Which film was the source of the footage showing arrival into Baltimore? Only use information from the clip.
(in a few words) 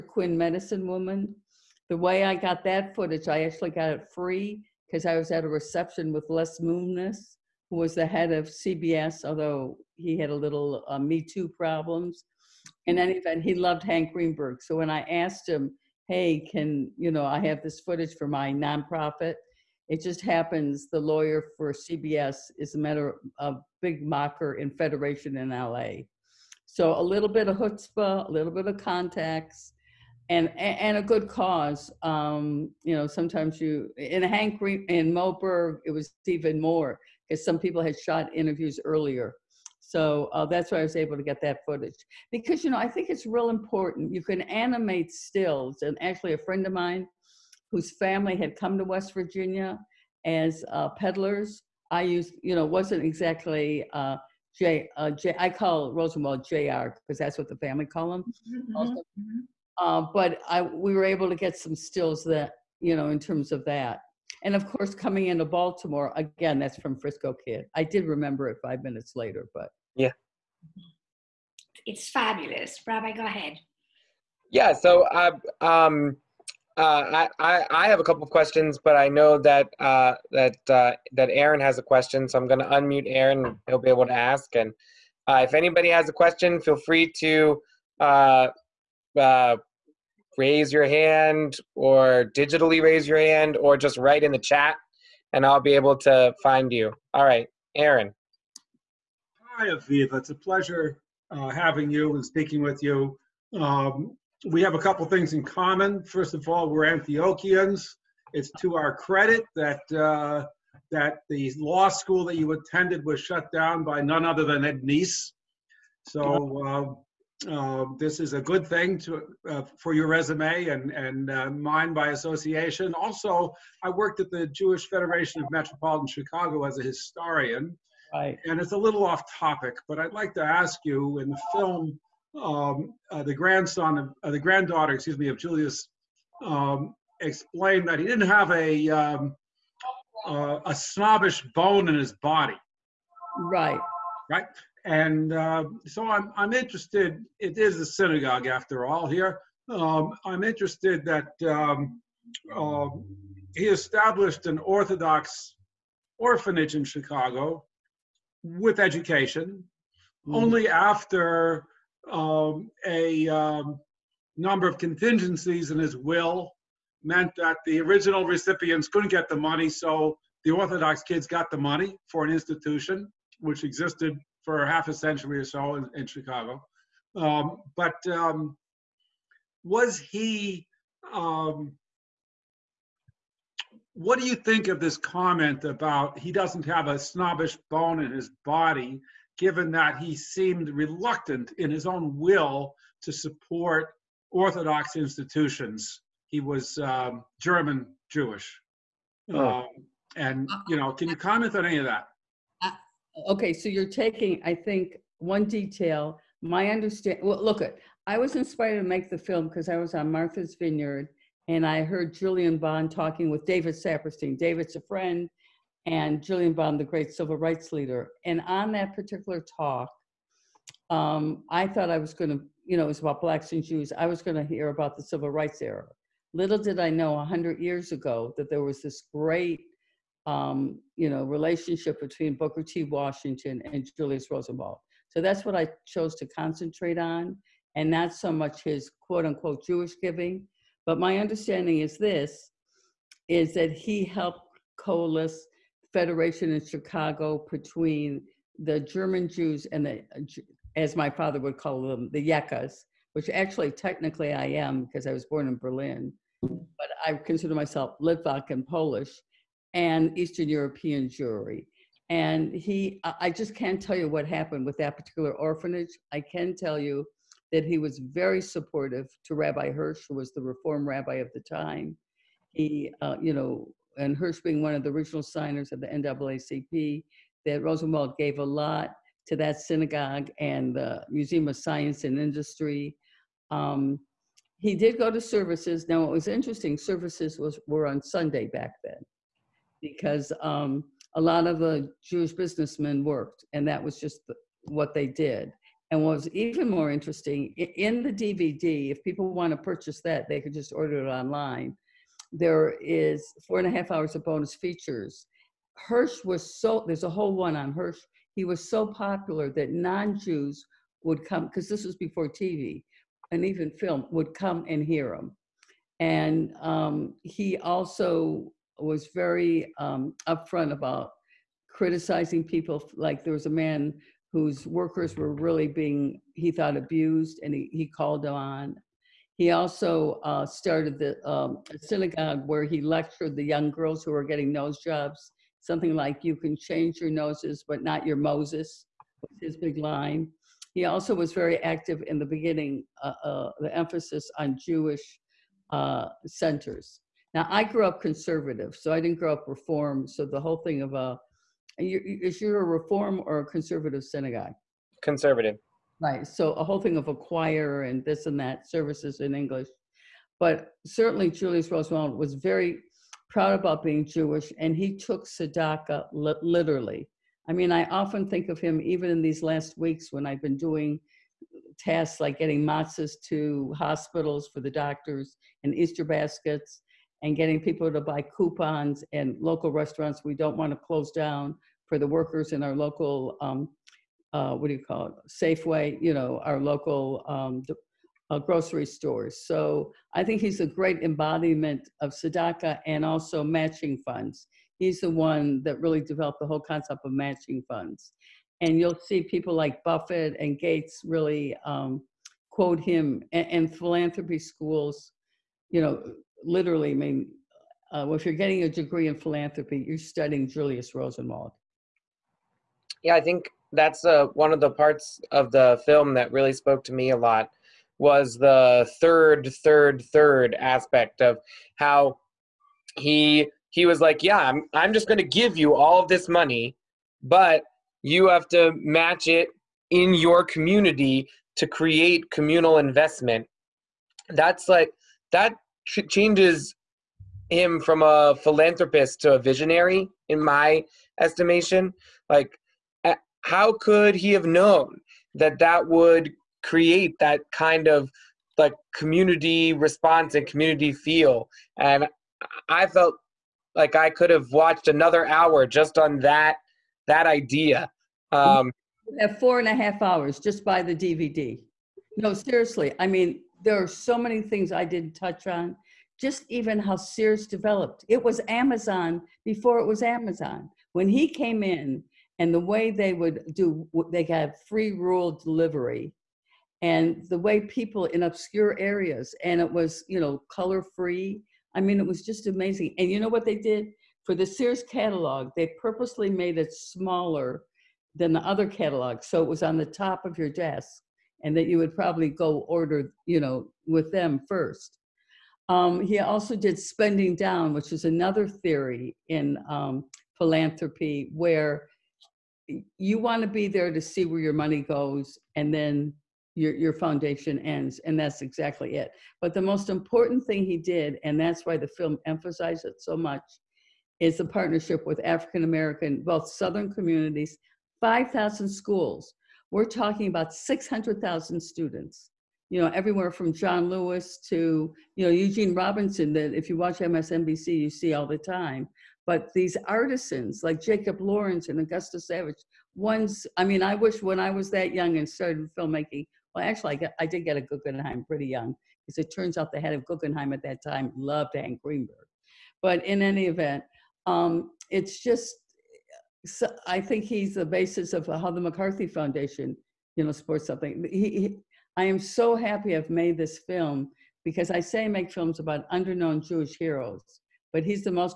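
Frisco Kid.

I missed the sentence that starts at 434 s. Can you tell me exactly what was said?
That's like that changes him from a philanthropist to a visionary, in my estimation.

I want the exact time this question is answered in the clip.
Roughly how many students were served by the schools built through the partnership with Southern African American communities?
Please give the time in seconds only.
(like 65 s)
520 s.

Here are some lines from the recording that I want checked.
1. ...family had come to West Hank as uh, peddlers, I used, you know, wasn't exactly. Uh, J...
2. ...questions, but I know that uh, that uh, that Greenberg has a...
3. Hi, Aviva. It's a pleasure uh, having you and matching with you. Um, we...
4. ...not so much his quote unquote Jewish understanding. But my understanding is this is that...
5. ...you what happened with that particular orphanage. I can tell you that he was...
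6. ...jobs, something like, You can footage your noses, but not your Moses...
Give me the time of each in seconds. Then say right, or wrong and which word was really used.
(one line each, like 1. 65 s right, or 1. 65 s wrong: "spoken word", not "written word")
1. 47 s wrong: "Virginia", not "Hank"
2. 78 s wrong: "Aaron", not "Greenberg"
3. 99 s wrong: "speaking", not "matching"
4. 237 s wrong: "giving", not "understanding"
5. 263 s right
6. 334 s wrong: "change", not "footage".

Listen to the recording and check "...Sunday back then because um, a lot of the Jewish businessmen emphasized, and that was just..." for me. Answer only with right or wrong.
wrong.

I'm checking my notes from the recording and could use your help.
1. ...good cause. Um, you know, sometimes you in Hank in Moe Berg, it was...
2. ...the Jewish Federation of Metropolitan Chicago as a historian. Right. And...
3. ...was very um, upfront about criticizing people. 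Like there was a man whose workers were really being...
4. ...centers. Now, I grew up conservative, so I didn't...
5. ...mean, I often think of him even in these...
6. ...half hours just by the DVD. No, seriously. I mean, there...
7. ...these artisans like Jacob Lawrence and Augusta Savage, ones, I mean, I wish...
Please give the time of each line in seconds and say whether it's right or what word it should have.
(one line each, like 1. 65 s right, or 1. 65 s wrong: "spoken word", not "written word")
1. 31 s right
2. 124 s right
3. 318 s right
4. 346 s right
5. 367 s right
6. 459 s right
7. 529 s right.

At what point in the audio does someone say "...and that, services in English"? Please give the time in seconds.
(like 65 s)
358 s.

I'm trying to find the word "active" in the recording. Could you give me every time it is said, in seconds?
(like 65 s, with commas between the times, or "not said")
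341 s.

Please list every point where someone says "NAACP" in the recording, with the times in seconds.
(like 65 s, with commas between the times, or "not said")
275 s.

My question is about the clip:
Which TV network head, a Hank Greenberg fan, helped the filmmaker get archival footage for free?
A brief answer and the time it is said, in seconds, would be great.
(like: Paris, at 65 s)
Les Moonves, at 6 s.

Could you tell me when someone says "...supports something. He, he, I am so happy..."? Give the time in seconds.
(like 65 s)
550 s.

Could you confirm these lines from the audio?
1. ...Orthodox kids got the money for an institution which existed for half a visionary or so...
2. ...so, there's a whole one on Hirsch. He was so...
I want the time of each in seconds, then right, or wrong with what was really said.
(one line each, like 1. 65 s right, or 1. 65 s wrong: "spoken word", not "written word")
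1. 170 s wrong: "century", not "visionary"
2. 306 s right.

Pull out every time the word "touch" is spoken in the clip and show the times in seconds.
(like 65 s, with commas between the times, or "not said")
465 s.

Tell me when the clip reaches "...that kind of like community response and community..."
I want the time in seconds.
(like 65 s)
447 s.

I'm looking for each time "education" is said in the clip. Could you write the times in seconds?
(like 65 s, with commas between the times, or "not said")
158 s.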